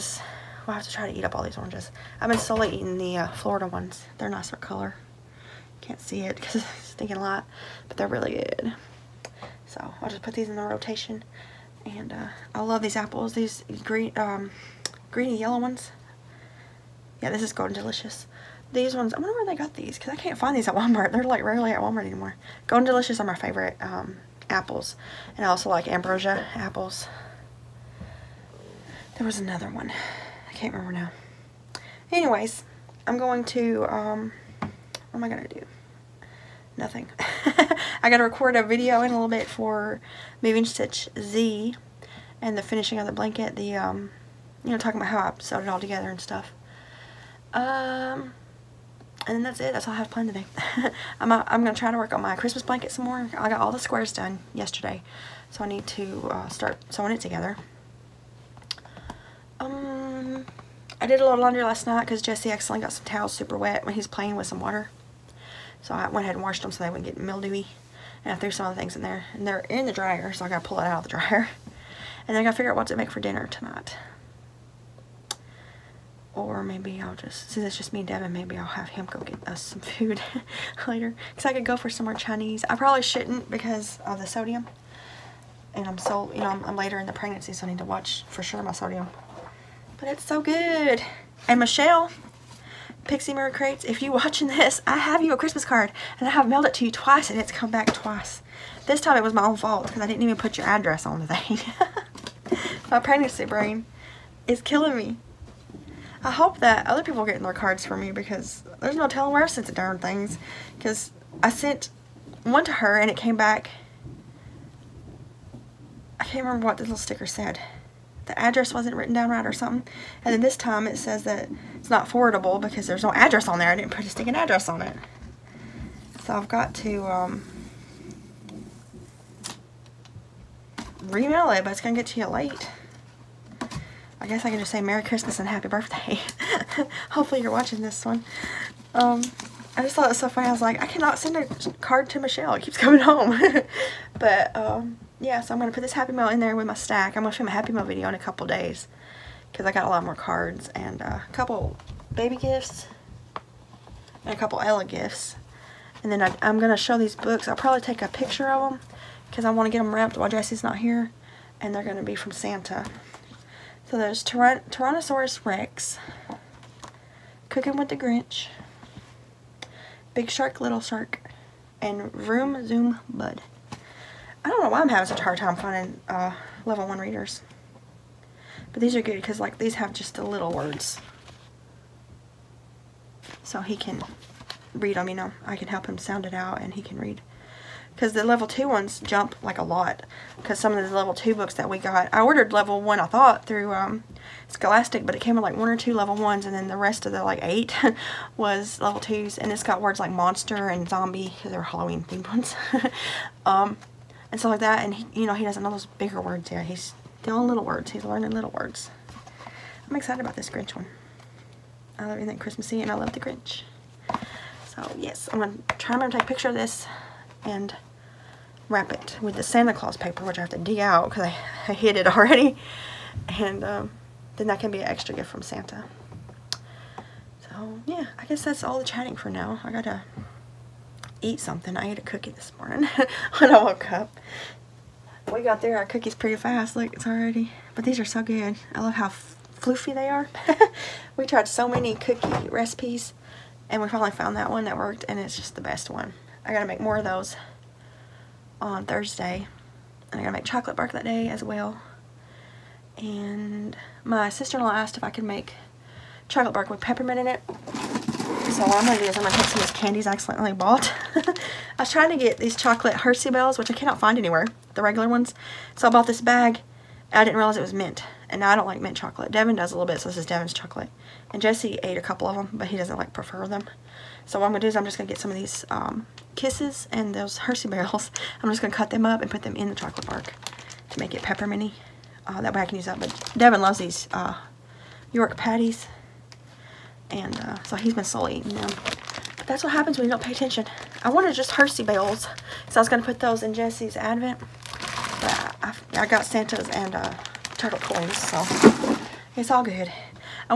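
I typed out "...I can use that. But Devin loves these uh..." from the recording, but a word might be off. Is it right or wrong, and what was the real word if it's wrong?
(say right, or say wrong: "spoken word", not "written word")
right.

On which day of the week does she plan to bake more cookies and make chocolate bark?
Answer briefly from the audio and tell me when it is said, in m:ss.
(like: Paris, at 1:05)
Thursday, at 4:08.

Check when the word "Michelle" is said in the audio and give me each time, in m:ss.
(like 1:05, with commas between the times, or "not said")
1:31, 2:22.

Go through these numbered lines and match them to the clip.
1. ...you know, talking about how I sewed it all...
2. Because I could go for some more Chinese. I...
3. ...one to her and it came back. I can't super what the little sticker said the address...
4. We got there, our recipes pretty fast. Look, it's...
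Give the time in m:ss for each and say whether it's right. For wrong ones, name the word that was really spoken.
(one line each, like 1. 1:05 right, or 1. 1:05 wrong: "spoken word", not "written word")
1. 0:44 right
2. 1:21 right
3. 1:52 wrong: "remember", not "super"
4. 3:55 wrong: "cookies", not "recipes".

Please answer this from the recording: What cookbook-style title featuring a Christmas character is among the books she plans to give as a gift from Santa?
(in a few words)
Cooking with the Grinch.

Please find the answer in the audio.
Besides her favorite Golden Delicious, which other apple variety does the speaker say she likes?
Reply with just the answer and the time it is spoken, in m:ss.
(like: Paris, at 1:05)
Ambrosia, at 0:25.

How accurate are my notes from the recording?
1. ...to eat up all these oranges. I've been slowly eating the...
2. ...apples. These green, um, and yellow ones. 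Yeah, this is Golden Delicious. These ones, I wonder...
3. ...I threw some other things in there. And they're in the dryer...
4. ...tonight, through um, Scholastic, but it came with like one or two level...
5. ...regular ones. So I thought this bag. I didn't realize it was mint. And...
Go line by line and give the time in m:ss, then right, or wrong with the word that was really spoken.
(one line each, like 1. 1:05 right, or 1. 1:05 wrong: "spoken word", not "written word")
1. 0:01 right
2. 0:12 right
3. 1:08 right
4. 3:13 wrong: "thought", not "tonight"
5. 4:24 wrong: "bought", not "thought".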